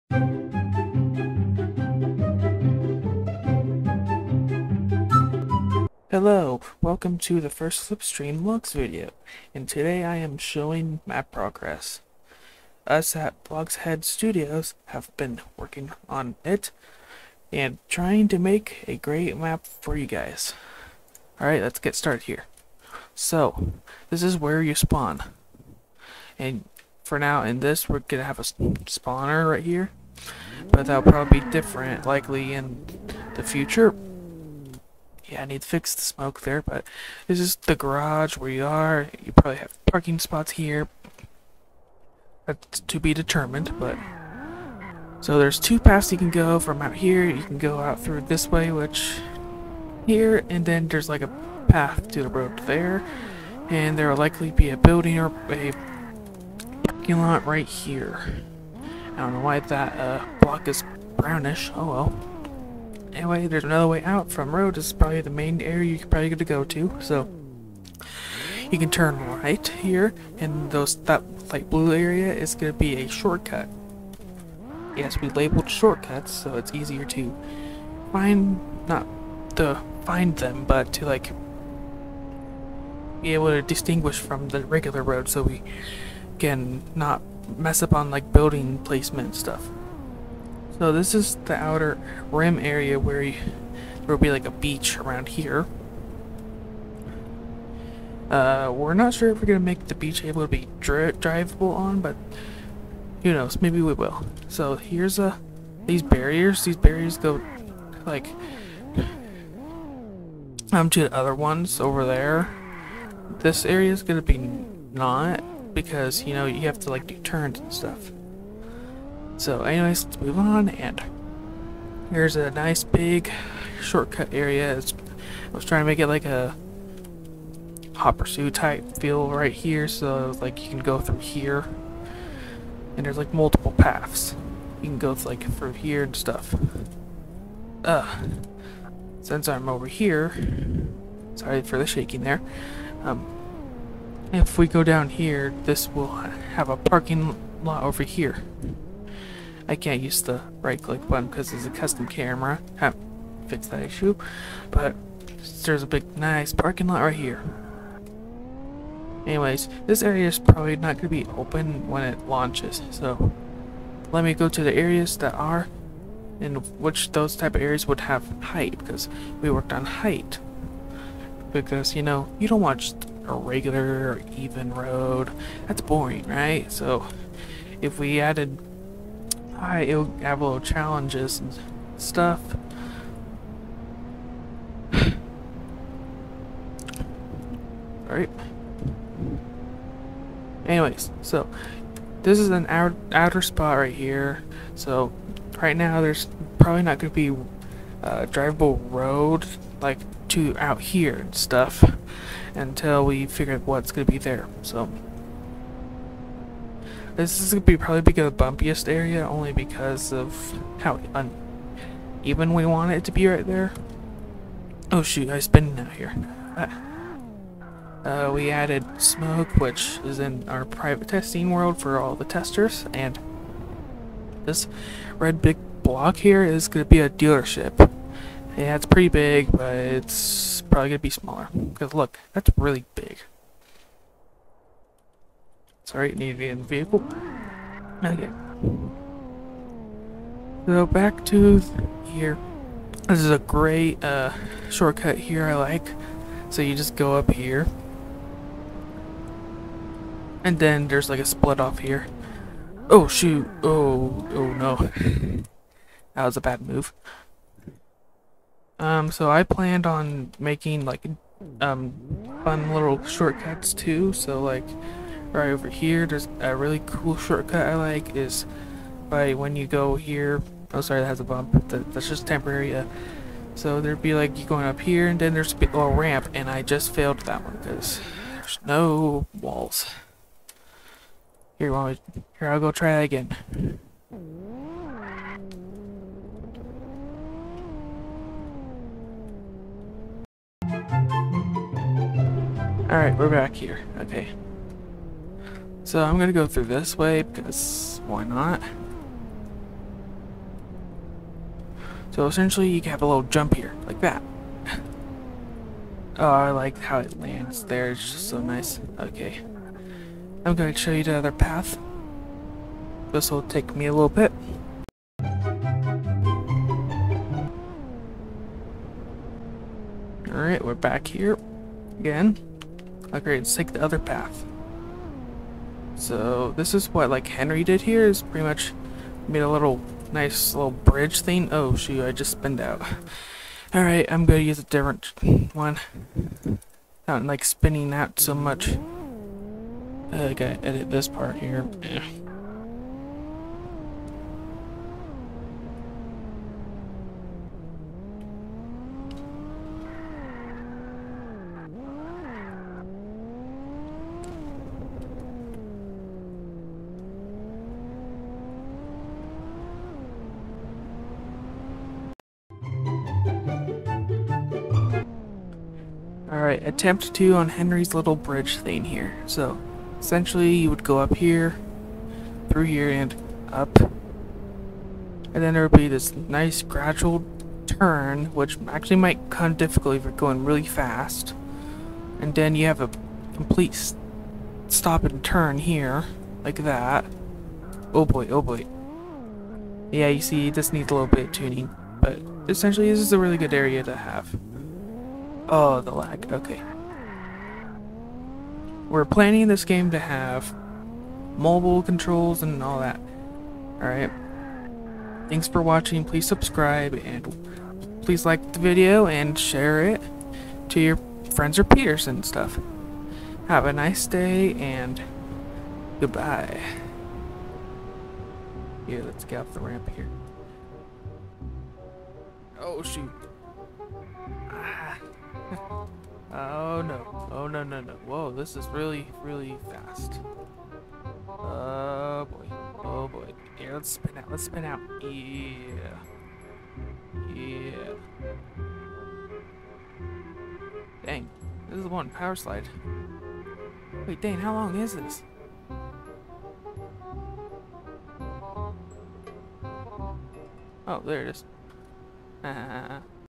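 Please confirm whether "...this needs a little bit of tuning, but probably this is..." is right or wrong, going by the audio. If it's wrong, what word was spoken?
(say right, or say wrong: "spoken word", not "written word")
wrong: "essentially", not "probably".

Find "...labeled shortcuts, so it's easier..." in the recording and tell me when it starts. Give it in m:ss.
1:15.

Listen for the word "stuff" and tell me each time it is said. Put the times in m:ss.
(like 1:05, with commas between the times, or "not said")
1:29, 1:57, 2:16, 3:01, 3:21, 6:52.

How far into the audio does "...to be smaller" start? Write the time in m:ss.
3:50.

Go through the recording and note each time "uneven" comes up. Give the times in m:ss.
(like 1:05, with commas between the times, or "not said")
3:32.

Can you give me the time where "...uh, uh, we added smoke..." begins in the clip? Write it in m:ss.
3:36.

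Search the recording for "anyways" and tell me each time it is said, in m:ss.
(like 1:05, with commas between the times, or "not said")
1:03, 1:59, 2:39, 3:10.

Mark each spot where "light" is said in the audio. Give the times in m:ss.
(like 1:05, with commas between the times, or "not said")
1:11.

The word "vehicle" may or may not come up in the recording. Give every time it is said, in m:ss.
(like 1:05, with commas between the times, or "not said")
3:56.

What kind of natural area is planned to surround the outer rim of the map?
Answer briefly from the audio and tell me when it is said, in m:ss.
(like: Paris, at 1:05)
a beach, at 1:34.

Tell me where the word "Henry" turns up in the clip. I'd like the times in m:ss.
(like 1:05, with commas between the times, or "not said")
5:27, 6:07.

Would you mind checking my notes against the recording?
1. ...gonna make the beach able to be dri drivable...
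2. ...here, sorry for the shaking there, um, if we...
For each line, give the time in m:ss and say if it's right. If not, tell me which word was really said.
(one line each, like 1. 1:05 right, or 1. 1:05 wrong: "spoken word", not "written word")
1. 1:39 right
2. 2:19 right.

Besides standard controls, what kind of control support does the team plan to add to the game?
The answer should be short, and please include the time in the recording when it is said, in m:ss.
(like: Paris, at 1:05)
mobile controls, at 6:41.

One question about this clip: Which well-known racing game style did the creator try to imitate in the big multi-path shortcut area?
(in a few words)
Hot Pursuit.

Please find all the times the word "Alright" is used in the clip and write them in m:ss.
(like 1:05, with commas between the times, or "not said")
0:21, 3:08, 4:52, 5:20, 5:33, 6:43.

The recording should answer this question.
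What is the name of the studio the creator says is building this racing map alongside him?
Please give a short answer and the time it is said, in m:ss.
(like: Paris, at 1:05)
BloxHead Studios, at 0:13.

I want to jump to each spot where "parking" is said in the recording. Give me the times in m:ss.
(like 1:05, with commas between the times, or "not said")
0:39, 0:56, 2:26, 2:36.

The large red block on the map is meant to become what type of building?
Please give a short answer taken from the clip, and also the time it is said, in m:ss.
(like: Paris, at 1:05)
a dealership, at 3:47.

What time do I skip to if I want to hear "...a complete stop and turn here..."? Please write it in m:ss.
6:22.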